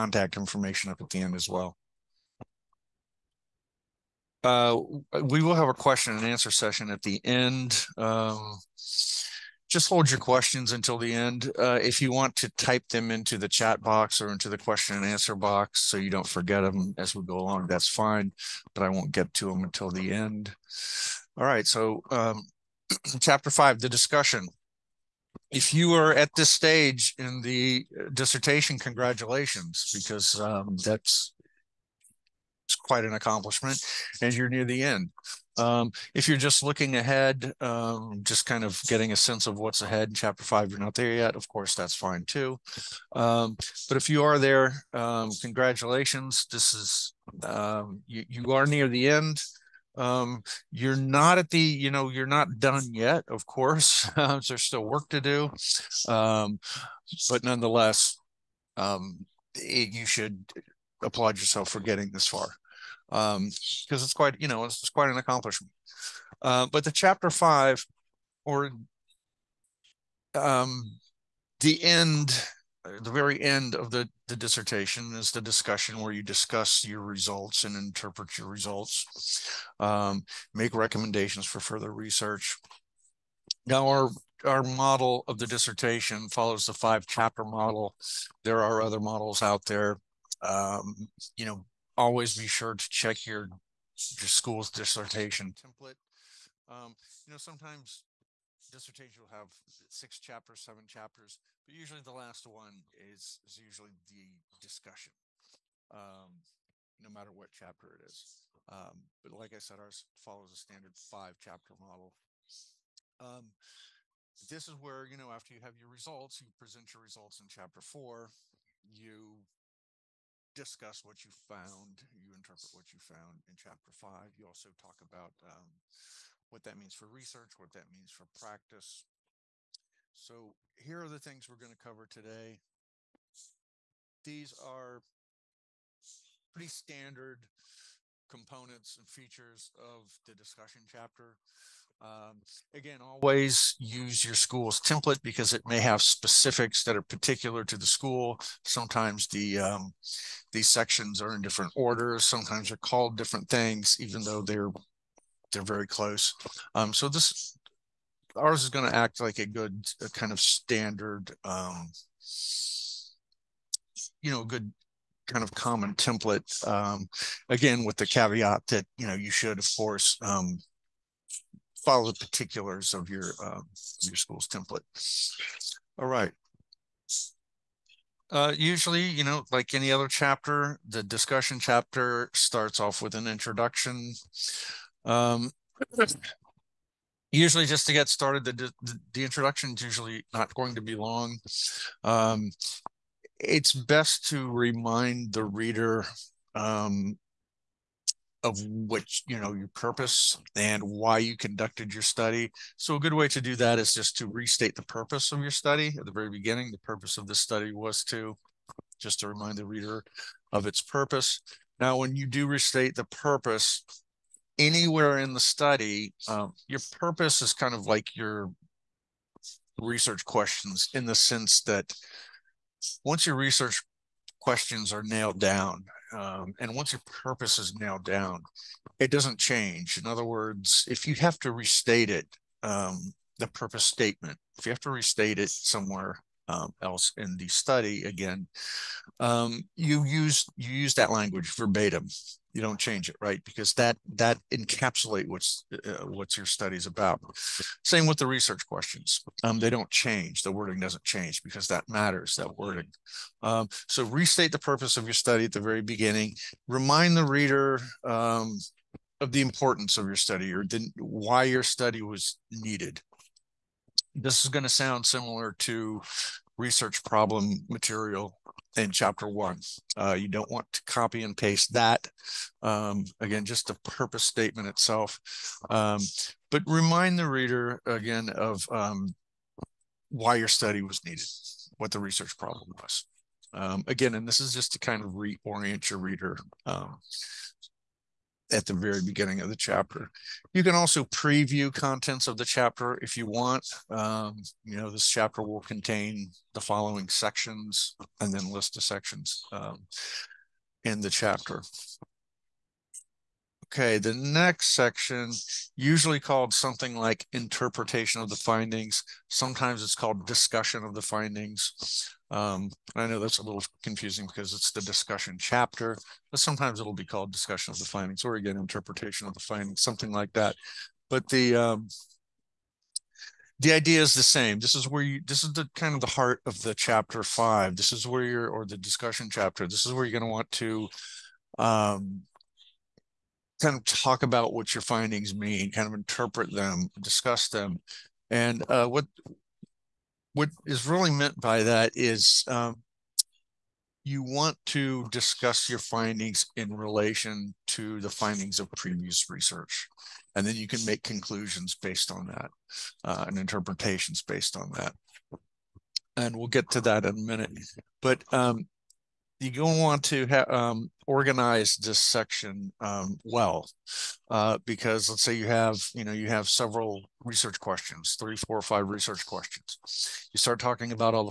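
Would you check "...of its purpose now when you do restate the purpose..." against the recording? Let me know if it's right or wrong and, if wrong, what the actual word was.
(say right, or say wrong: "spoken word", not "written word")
right.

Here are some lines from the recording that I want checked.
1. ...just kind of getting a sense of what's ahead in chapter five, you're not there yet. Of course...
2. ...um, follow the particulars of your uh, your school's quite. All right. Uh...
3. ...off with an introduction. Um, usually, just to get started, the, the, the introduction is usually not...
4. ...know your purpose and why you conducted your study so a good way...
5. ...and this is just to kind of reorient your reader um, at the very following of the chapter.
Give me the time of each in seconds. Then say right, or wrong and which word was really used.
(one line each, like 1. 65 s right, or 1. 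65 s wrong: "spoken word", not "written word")
1. 38 s right
2. 170 s wrong: "template", not "quite"
3. 182 s right
4. 199 s right
5. 284 s wrong: "beginning", not "following".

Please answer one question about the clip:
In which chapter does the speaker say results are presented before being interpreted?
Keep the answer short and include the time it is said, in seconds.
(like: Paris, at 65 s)
chapter four, at 117 s.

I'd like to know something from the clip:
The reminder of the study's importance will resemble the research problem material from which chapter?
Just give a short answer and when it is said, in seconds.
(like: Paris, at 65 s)
chapter one, at 268 s.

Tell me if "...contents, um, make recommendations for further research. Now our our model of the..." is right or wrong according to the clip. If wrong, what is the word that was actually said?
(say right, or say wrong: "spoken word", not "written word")
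wrong: "results", not "contents".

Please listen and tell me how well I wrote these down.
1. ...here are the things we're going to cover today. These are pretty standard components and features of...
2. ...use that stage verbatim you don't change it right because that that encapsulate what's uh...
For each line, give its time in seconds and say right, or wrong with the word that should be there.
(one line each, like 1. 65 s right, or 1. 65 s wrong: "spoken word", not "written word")
1. 130 s right
2. 240 s wrong: "language", not "stage".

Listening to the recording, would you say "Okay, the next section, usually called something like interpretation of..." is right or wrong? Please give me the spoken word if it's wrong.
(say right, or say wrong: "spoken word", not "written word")
right.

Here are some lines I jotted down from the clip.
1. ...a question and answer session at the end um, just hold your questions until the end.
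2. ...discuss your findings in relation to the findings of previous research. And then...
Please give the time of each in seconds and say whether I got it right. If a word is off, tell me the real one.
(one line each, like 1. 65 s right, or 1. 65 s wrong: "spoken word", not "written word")
1. 5 s right
2. 345 s right.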